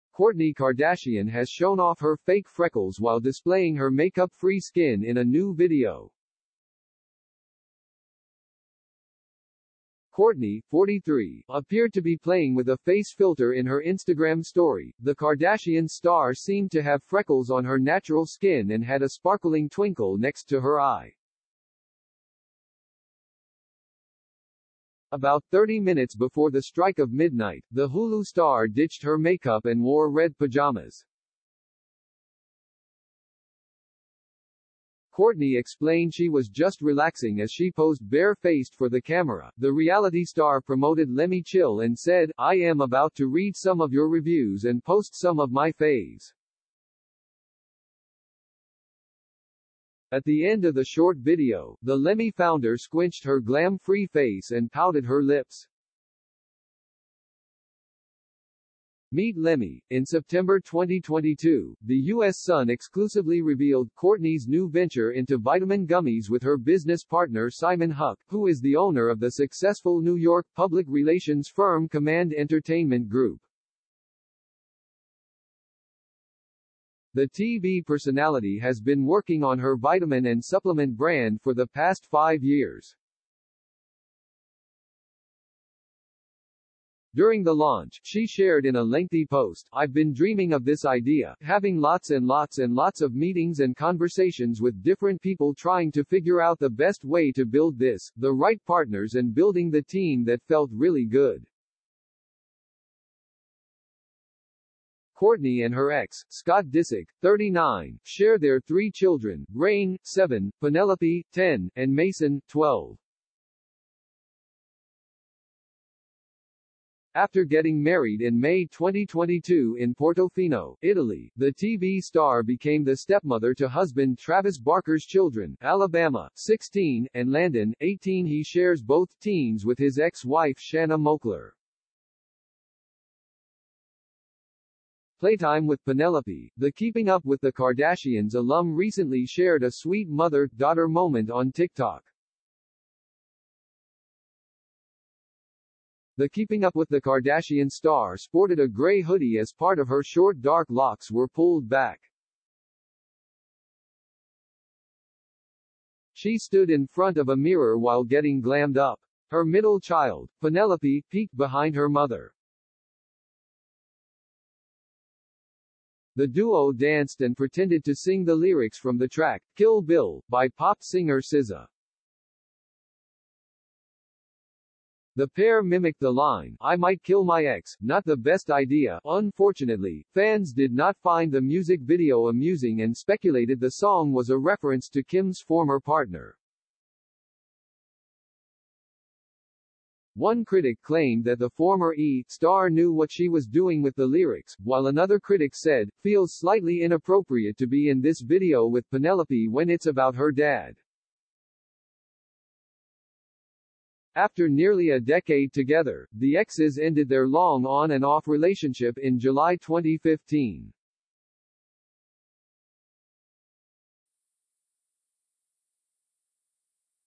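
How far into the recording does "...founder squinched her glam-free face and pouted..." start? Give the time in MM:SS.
00:52.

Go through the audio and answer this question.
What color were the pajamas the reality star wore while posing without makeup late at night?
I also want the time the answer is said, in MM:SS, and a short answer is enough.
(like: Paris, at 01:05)
red, at 00:30.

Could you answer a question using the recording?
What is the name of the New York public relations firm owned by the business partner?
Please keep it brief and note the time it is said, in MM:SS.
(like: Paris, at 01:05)
Command Entertainment Group, at 01:11.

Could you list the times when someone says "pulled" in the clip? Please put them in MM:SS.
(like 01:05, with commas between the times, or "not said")
02:31.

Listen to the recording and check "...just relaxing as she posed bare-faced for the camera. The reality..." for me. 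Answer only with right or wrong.
right.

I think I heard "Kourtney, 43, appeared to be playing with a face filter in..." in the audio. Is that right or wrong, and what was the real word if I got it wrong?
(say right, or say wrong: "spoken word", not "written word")
right.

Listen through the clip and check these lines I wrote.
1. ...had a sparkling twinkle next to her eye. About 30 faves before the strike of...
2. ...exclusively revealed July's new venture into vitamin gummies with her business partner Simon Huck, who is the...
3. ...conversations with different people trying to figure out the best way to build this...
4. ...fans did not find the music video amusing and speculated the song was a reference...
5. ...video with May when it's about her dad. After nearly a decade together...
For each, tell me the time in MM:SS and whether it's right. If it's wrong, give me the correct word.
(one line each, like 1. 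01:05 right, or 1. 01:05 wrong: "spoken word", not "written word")
1. 00:18 wrong: "minutes", not "faves"
2. 01:02 wrong: "Kourtney", not "July"
3. 01:33 right
4. 03:00 right
5. 03:18 wrong: "Penelope", not "May".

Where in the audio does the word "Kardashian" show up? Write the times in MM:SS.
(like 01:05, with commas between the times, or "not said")
00:00, 00:15, 02:17, 02:26.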